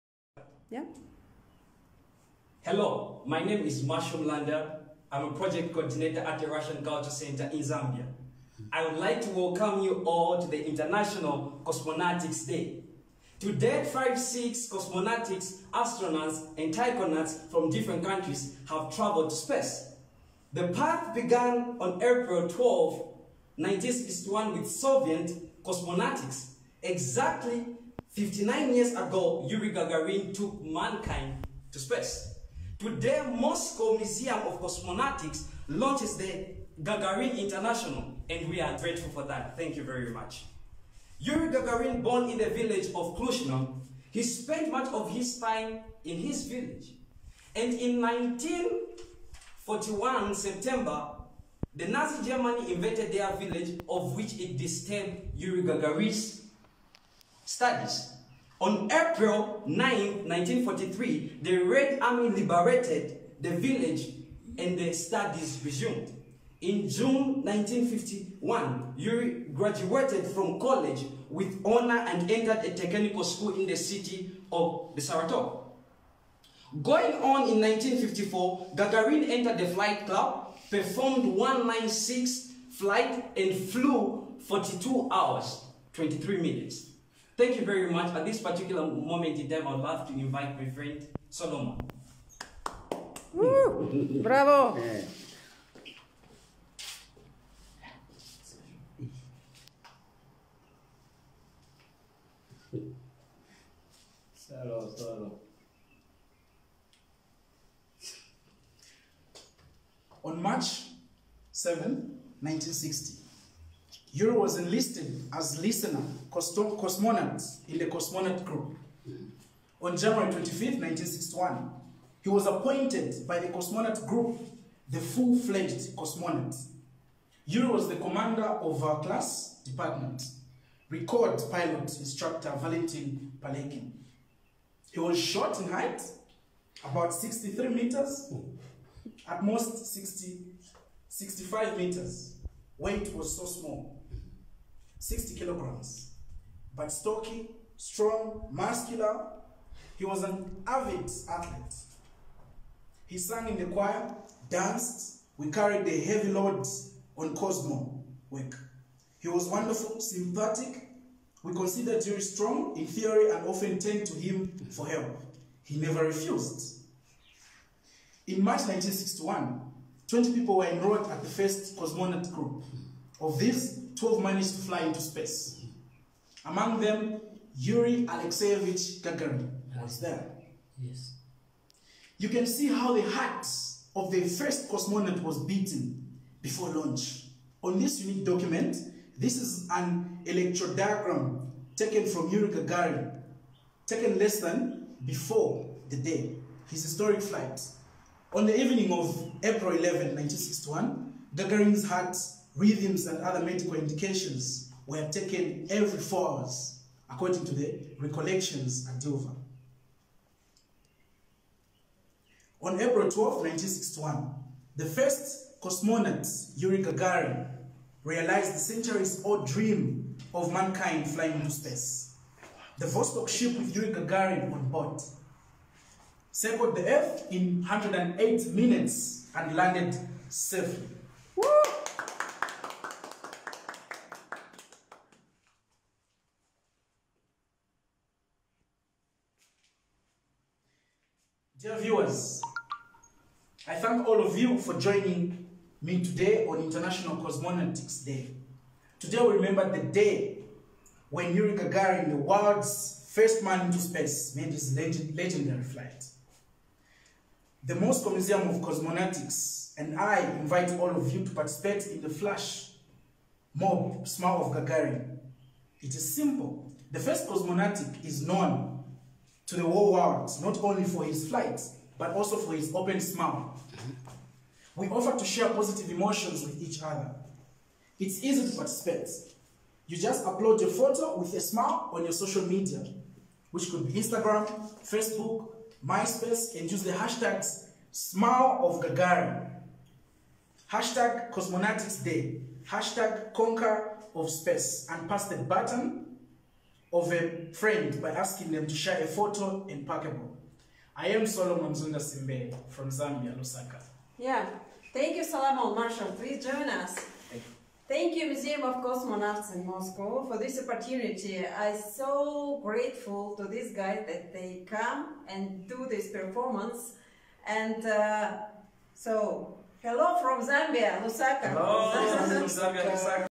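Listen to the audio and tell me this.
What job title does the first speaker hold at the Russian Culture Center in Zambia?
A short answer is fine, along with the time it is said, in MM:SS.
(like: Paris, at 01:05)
Project coordinator, at 00:05.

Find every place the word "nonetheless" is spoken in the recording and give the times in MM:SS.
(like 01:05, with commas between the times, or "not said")
not said.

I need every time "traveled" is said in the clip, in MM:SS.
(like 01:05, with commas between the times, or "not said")
00:18.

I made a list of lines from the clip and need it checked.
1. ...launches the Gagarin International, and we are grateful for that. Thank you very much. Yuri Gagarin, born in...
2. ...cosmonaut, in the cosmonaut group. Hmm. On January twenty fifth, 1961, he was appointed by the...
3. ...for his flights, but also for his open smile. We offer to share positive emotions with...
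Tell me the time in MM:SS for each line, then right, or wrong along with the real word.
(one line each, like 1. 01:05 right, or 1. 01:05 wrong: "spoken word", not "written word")
1. 00:35 right
2. 01:56 right
3. 04:30 right.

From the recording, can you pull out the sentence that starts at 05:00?
I am Solomon Zunda Simbe from Zambia, Lusaka.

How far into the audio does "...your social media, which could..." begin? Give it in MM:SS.
04:42.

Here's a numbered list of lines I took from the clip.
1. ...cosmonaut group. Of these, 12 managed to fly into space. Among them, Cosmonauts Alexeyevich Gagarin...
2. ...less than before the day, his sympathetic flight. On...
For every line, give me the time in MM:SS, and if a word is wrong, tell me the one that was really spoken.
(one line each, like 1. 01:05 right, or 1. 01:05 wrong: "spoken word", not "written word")
1. 02:51 wrong: "Yuri", not "Cosmonauts"
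2. 03:14 wrong: "historic", not "sympathetic".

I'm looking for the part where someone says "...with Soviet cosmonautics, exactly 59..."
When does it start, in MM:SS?
00:24.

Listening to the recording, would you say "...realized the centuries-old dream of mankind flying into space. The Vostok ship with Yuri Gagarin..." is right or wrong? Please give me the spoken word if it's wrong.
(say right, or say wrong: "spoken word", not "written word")
right.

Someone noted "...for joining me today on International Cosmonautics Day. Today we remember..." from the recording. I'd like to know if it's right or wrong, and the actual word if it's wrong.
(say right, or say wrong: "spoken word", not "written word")
right.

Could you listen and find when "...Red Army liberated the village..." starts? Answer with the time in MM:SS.
01:01.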